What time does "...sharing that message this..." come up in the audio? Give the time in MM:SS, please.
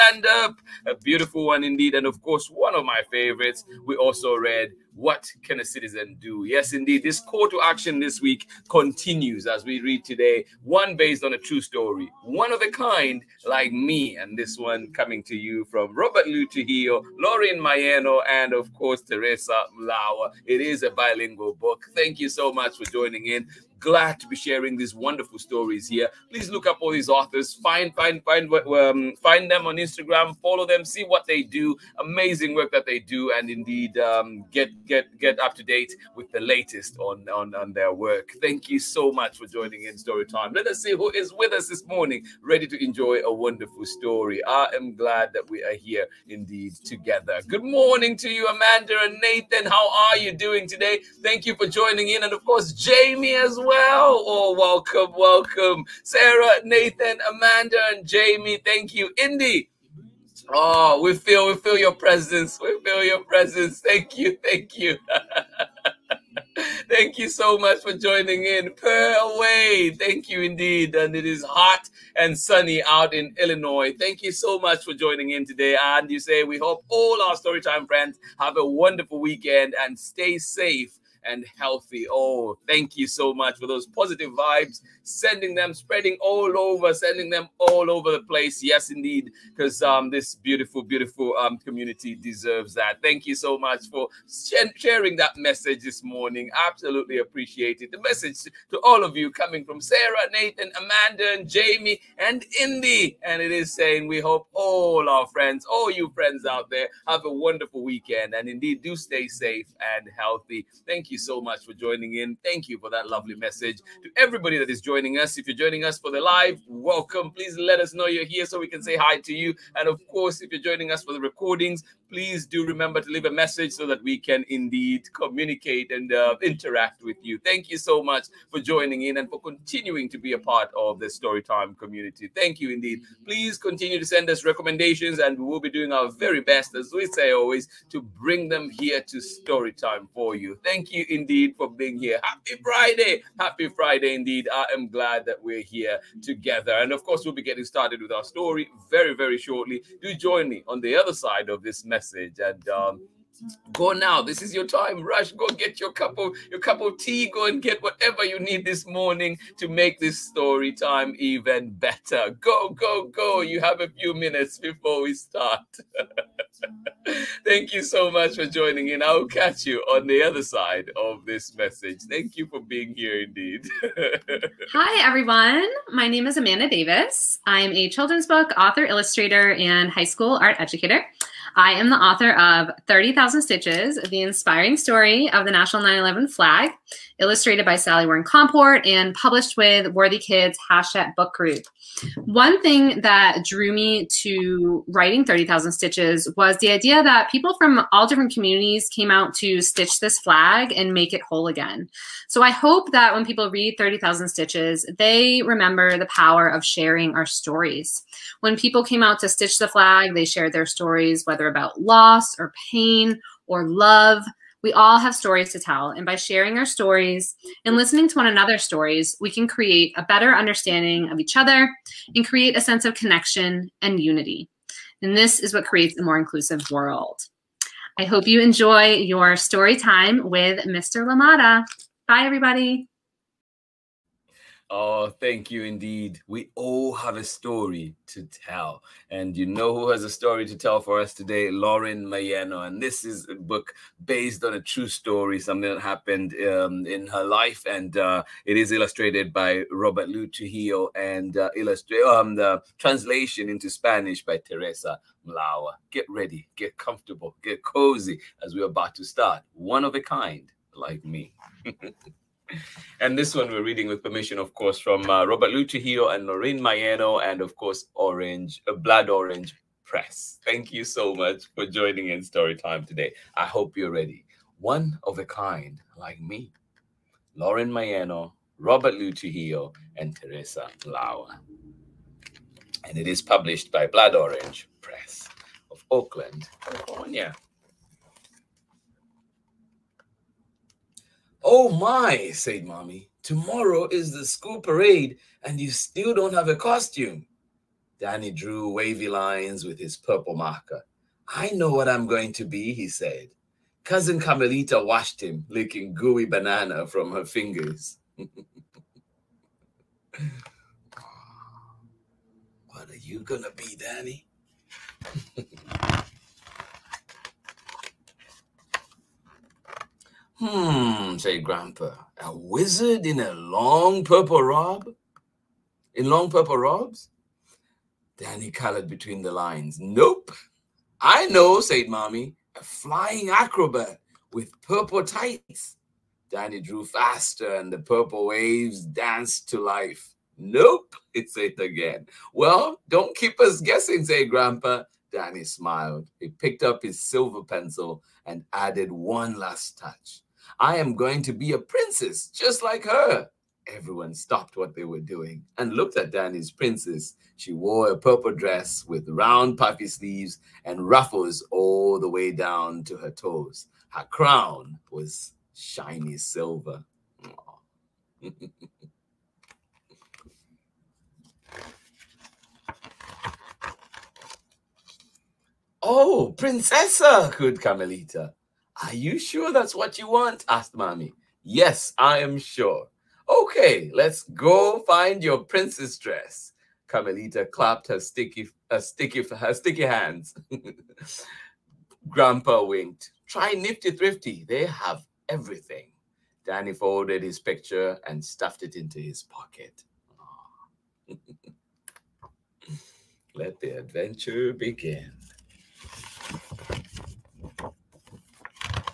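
01:34.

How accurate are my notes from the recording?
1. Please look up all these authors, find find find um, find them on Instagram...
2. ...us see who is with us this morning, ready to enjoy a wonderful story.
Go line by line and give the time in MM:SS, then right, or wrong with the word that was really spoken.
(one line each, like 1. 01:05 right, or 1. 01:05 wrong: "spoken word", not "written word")
1. 00:26 right
2. 00:40 right.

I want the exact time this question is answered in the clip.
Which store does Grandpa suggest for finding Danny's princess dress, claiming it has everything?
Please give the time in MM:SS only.
06:33.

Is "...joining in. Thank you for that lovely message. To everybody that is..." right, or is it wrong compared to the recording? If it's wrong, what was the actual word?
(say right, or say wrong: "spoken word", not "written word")
right.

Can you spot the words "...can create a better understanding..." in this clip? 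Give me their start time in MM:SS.
03:39.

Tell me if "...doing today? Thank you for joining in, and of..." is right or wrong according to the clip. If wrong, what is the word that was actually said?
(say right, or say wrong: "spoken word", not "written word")
right.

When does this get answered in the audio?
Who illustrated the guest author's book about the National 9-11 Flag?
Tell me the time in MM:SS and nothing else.
03:07.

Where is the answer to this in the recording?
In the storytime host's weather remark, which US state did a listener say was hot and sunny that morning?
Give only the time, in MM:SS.
01:13.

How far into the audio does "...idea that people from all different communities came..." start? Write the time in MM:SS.
03:16.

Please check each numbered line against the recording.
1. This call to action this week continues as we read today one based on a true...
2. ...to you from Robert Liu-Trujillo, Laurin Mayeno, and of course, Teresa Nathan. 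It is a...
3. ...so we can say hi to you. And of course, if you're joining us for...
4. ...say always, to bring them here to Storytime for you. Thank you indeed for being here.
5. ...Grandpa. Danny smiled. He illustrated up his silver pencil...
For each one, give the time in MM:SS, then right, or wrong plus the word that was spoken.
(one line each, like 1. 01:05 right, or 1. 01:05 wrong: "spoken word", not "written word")
1. 00:07 right
2. 00:15 wrong: "Mlawer", not "Nathan"
3. 01:58 right
4. 02:17 right
5. 05:44 wrong: "picked", not "illustrated".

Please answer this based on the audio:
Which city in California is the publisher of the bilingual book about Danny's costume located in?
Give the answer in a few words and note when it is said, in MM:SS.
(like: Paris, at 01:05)
Oakland, at 04:45.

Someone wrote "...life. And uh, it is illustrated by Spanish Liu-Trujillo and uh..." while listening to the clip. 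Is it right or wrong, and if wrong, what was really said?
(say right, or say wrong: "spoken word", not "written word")
wrong: "Robert", not "Spanish".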